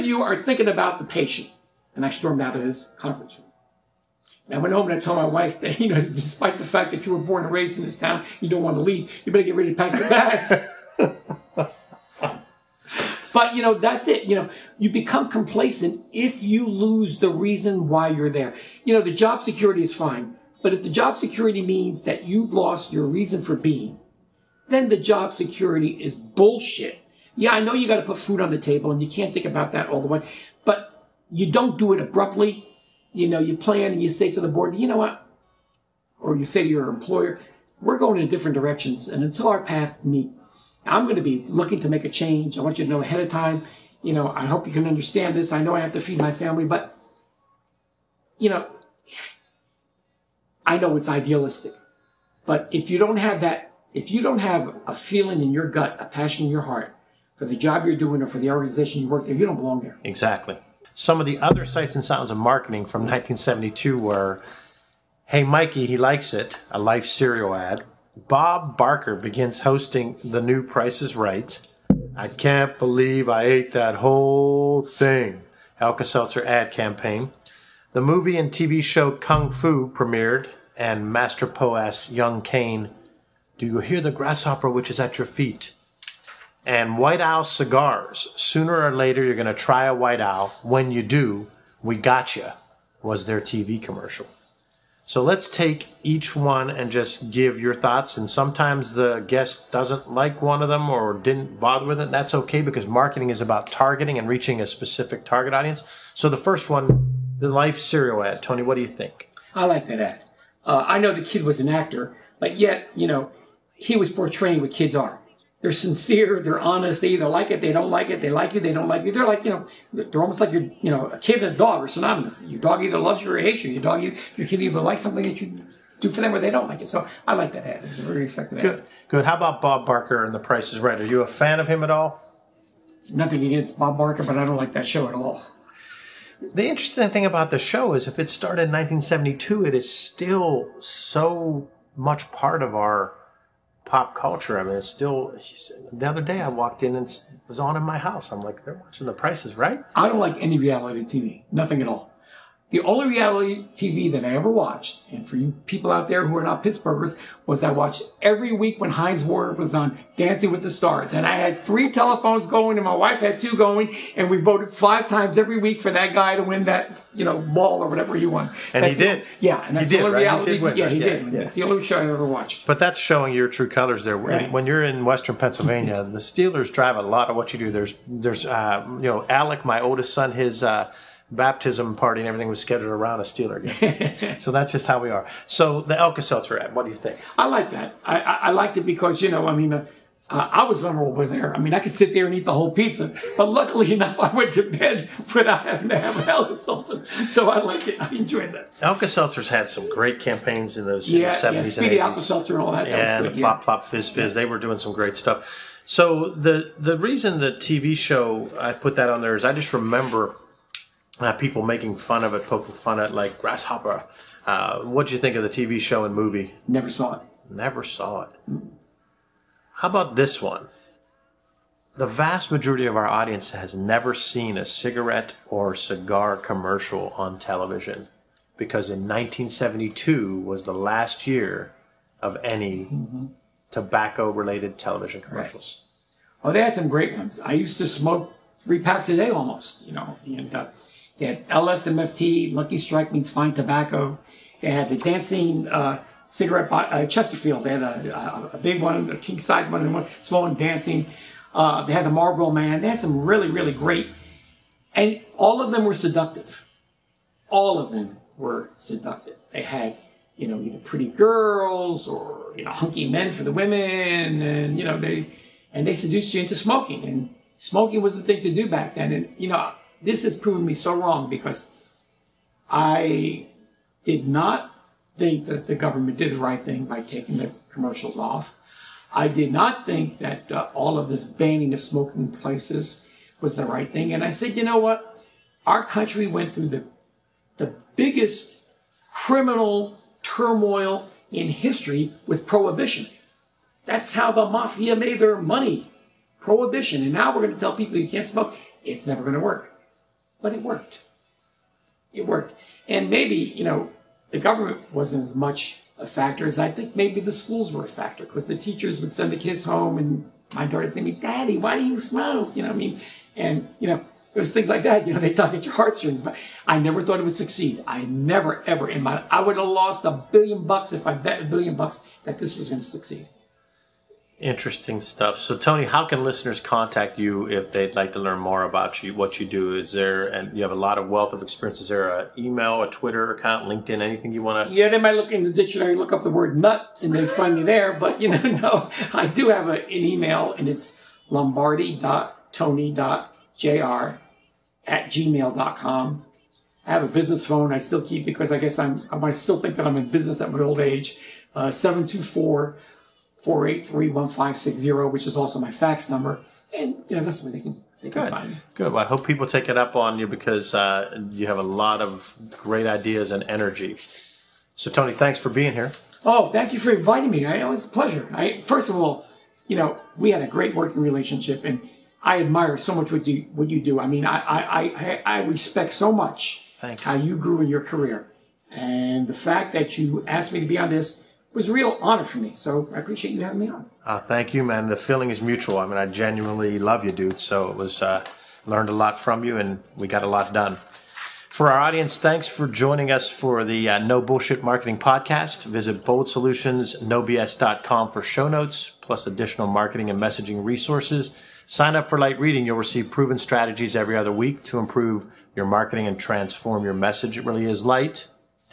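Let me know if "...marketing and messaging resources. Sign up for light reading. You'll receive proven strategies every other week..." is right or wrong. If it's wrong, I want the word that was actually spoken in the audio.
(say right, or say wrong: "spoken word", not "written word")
right.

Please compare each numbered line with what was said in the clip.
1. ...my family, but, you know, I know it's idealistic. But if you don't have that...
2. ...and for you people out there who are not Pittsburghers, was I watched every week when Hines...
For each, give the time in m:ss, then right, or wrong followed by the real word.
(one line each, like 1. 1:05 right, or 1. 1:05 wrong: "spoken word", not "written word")
1. 0:46 right
2. 2:35 right.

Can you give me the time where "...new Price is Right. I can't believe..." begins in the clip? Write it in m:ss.
1:10.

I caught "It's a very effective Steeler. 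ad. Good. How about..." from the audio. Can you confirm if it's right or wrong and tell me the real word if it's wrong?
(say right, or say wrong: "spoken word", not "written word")
wrong: "Good", not "Steeler".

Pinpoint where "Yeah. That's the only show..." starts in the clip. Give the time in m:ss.
2:51.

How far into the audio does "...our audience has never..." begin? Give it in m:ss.
3:42.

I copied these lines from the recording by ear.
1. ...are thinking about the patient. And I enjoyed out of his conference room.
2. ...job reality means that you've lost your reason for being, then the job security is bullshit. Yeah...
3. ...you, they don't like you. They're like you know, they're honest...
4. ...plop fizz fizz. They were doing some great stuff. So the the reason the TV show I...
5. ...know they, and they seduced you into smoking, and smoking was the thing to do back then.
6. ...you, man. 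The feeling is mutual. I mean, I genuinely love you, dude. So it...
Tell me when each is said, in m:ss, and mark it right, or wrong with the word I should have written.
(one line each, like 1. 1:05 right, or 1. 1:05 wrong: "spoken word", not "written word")
1. 0:00 wrong: "stormed", not "enjoyed"
2. 0:20 wrong: "security", not "reality"
3. 1:58 wrong: "almost", not "honest"
4. 3:23 right
5. 4:24 right
6. 6:24 right.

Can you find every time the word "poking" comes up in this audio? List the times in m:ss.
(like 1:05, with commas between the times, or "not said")
3:32.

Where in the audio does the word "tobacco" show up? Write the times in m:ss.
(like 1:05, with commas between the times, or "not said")
3:53, 4:03.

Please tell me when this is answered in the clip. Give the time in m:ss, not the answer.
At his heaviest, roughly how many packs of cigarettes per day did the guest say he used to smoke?
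3:58.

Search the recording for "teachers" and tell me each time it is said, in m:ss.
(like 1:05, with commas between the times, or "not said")
5:08.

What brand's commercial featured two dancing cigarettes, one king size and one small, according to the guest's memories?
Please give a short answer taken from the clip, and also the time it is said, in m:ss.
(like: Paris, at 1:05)
Chesterfield, at 4:07.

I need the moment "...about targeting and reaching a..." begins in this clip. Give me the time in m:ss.
1:43.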